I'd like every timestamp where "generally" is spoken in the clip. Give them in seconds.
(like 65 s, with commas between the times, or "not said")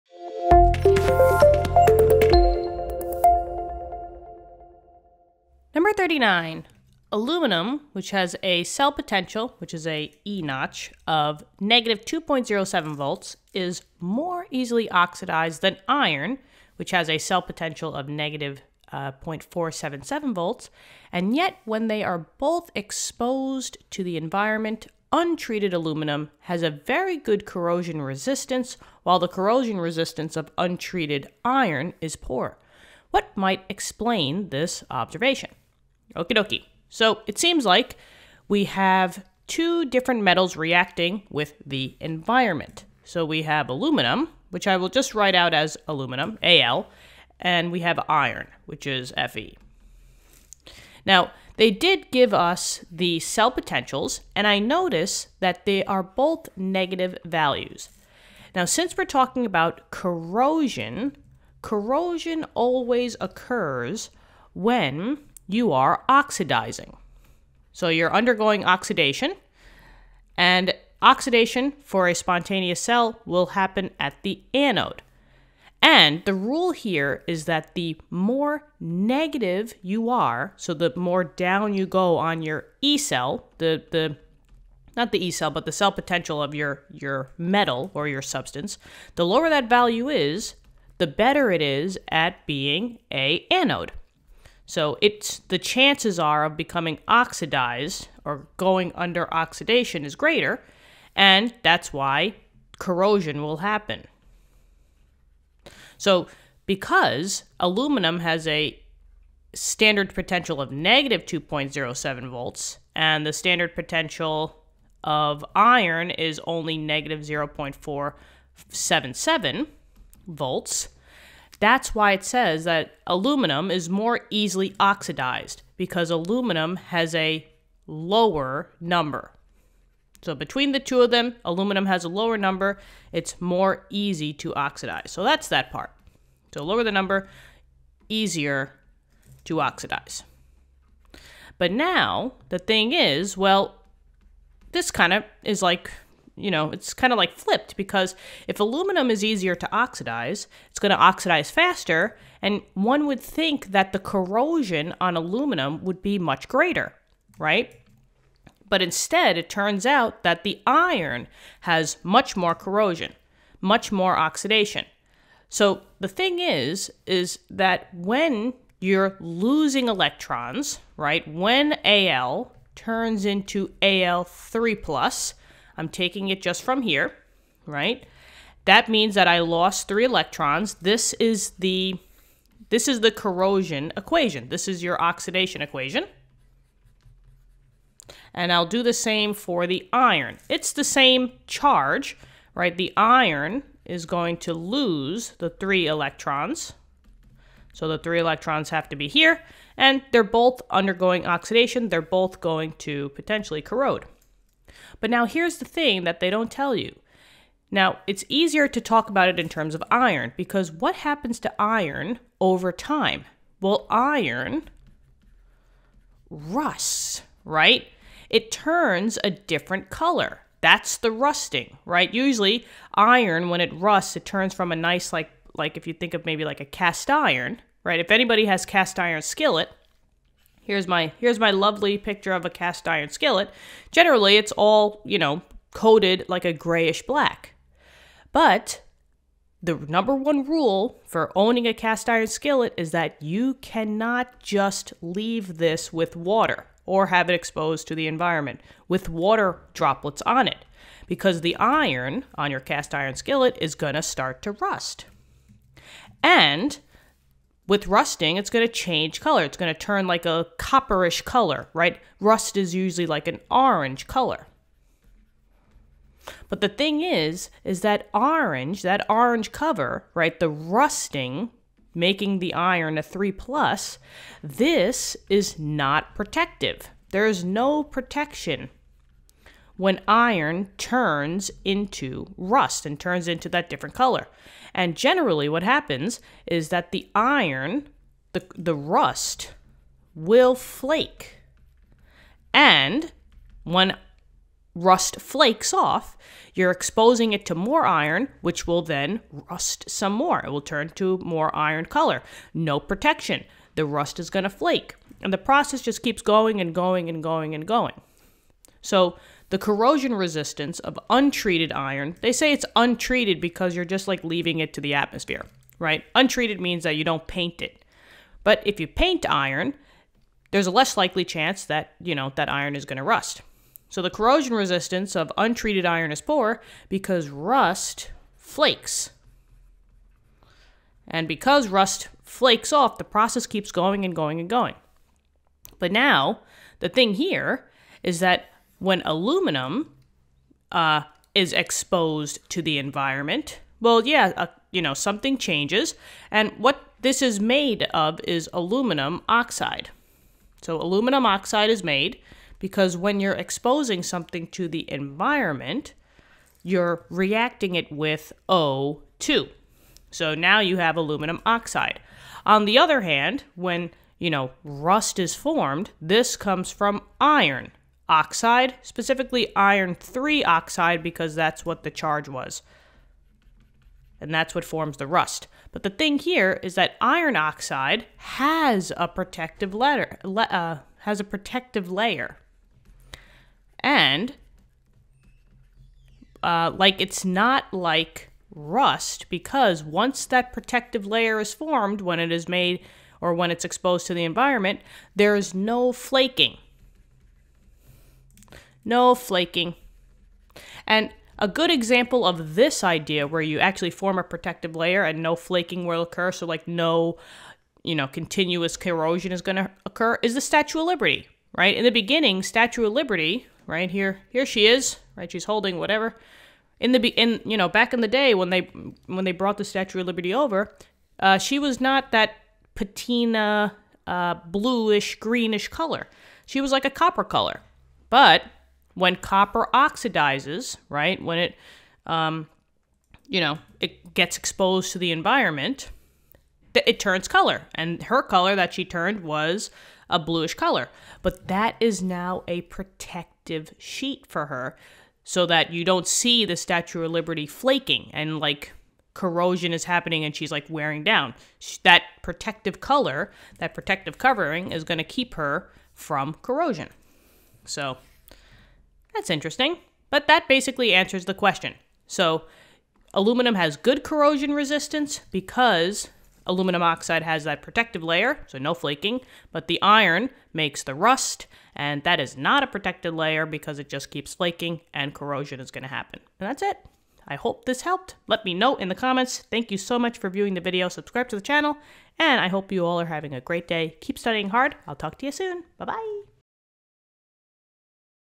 233 s, 284 s.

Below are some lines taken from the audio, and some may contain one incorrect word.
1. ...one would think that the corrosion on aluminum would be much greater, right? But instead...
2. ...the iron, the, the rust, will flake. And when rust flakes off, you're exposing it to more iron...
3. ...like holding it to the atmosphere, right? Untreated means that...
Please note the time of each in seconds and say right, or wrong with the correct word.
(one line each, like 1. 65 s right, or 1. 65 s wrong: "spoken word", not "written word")
1. 152 s right
2. 286 s right
3. 314 s wrong: "leaving", not "holding".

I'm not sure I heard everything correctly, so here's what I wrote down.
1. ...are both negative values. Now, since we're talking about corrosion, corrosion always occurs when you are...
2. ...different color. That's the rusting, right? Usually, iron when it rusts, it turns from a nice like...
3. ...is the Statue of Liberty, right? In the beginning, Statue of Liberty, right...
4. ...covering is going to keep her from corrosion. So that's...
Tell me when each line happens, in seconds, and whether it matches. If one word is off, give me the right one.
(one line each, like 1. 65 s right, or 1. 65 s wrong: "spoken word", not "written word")
1. 55 s right
2. 219 s right
3. 410 s right
4. 454 s right.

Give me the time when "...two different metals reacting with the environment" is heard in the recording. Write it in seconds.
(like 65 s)
39 s.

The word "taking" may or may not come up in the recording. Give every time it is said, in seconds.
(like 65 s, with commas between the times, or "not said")
175 s.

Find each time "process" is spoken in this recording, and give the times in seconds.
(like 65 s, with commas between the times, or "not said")
305 s, 333 s.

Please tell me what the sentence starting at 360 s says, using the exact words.
So now you have aluminum oxide.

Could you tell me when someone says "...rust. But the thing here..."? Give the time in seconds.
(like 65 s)
375 s.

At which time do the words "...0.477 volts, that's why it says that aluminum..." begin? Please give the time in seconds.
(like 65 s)
117 s.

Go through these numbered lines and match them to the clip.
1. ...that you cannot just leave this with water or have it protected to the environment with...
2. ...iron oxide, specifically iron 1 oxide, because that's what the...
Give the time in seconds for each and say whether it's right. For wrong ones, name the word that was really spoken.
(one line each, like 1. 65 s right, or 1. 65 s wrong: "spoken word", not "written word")
1. 242 s wrong: "exposed", not "protected"
2. 367 s wrong: "3", not "1".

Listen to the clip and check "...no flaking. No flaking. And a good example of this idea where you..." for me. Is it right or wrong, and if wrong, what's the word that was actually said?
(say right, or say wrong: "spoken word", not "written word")
right.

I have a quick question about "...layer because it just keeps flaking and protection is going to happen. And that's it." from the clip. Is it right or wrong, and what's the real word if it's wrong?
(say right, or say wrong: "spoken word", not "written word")
wrong: "corrosion", not "protection".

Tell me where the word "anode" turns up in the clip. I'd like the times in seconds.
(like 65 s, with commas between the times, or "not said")
74 s, 93 s.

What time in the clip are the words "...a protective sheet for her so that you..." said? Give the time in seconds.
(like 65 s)
442 s.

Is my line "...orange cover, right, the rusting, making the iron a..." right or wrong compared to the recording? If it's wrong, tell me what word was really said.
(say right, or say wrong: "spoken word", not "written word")
right.